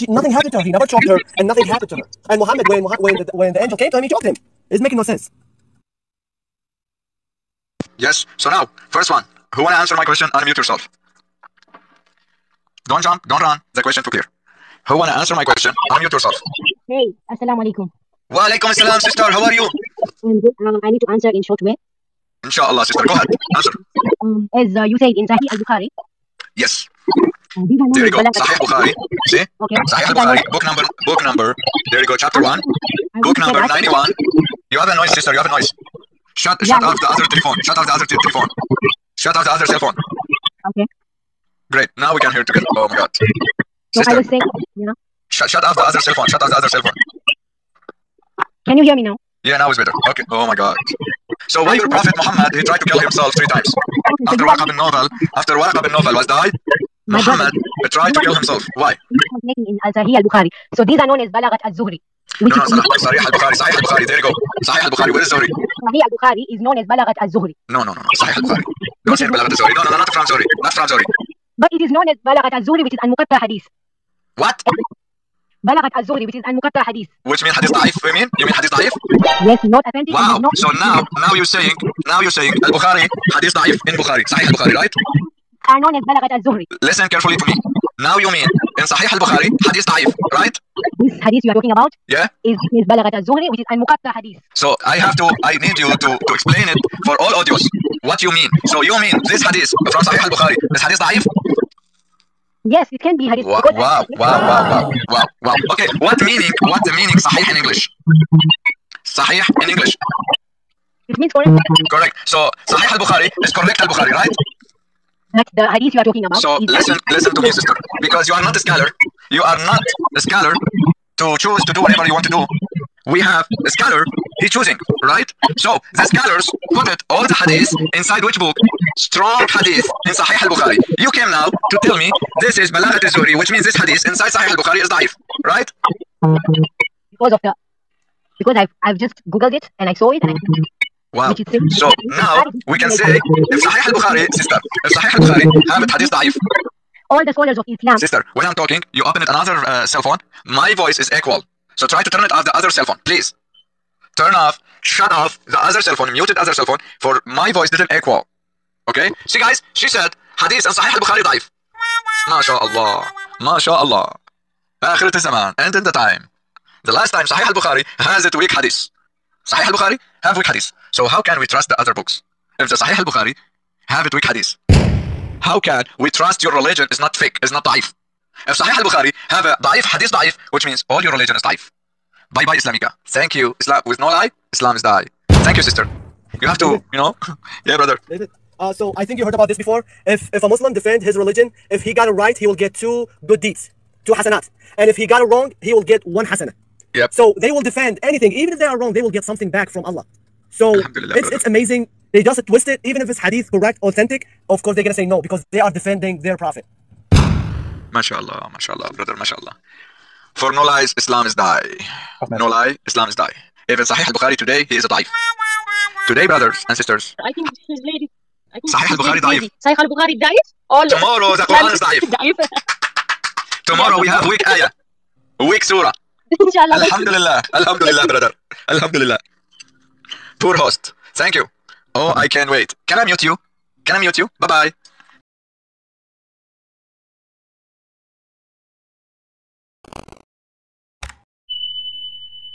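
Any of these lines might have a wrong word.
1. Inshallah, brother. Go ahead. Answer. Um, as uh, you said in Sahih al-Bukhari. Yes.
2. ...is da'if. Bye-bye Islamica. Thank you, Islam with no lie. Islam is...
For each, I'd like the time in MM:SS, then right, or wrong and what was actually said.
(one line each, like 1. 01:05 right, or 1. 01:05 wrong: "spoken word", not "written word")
1. 00:22 wrong: "sister", not "brother"
2. 03:01 right.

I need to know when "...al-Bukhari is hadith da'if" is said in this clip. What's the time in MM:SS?
01:40.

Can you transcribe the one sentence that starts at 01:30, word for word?
This Hadith you are talking about?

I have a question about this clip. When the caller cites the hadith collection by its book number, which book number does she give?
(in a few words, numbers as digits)
91.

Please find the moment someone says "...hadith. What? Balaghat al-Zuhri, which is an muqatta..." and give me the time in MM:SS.
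01:13.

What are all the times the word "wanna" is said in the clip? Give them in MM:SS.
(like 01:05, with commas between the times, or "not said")
00:09, 00:14.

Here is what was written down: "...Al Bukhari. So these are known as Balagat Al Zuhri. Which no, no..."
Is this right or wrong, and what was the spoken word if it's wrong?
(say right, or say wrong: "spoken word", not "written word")
right.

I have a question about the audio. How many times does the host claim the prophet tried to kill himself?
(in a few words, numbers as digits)
3.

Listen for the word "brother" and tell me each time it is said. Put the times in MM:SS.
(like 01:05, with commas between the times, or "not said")
03:07, 03:20, 03:28, 03:36.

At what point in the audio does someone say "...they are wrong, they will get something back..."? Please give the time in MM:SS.
03:18.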